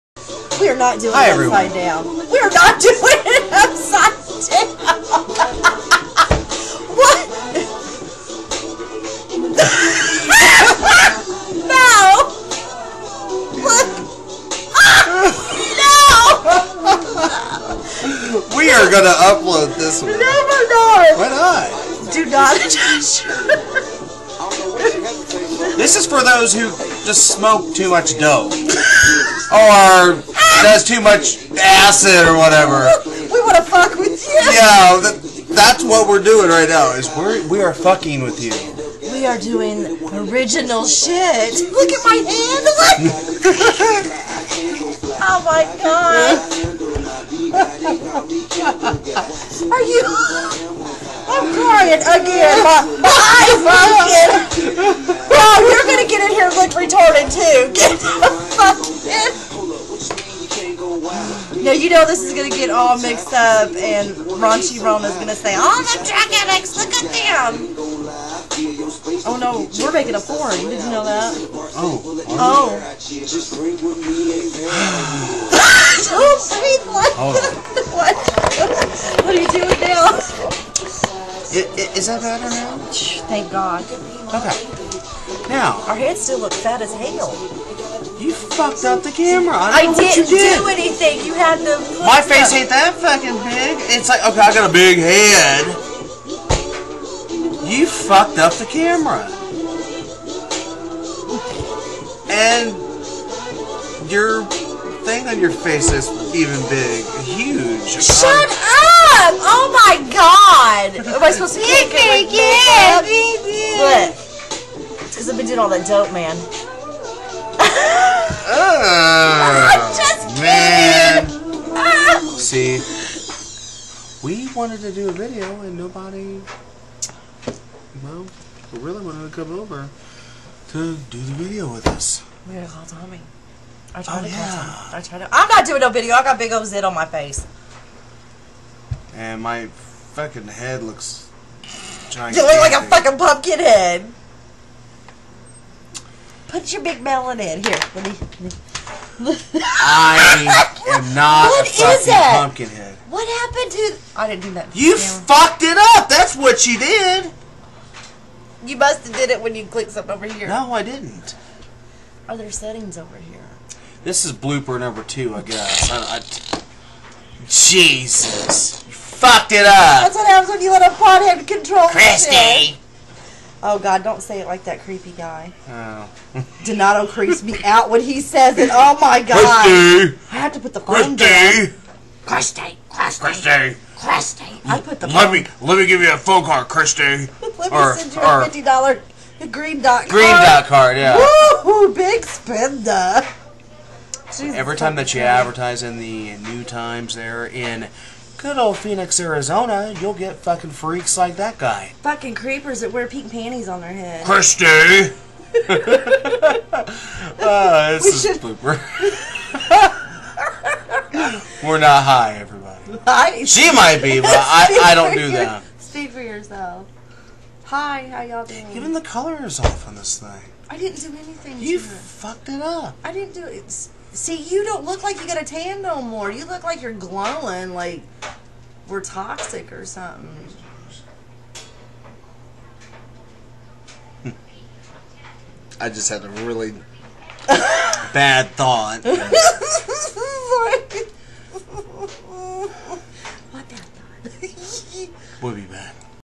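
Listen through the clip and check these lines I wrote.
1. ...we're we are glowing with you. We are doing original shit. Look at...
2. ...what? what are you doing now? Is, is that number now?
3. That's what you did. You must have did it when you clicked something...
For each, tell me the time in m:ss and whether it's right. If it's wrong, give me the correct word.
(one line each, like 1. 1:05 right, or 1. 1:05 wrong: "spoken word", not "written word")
1. 0:37 wrong: "fucking", not "glowing"
2. 1:17 wrong: "better", not "number"
3. 2:36 right.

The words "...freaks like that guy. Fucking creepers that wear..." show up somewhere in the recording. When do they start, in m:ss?
3:20.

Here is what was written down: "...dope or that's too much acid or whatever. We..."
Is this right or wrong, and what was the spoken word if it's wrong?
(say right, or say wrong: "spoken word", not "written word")
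right.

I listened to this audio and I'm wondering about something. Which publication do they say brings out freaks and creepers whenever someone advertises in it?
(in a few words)
New Times.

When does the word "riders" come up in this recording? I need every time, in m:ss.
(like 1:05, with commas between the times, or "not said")
not said.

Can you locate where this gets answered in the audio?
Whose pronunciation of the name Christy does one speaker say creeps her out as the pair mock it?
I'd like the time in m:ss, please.
2:56.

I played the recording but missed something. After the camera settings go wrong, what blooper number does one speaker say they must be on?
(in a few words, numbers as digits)
2.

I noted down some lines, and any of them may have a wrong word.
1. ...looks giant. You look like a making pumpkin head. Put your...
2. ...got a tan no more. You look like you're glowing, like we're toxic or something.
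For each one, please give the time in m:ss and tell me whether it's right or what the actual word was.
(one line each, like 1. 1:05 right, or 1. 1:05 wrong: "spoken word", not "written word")
1. 2:20 wrong: "fucking", not "making"
2. 3:45 right.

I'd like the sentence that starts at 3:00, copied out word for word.
I have to put the phone Christy.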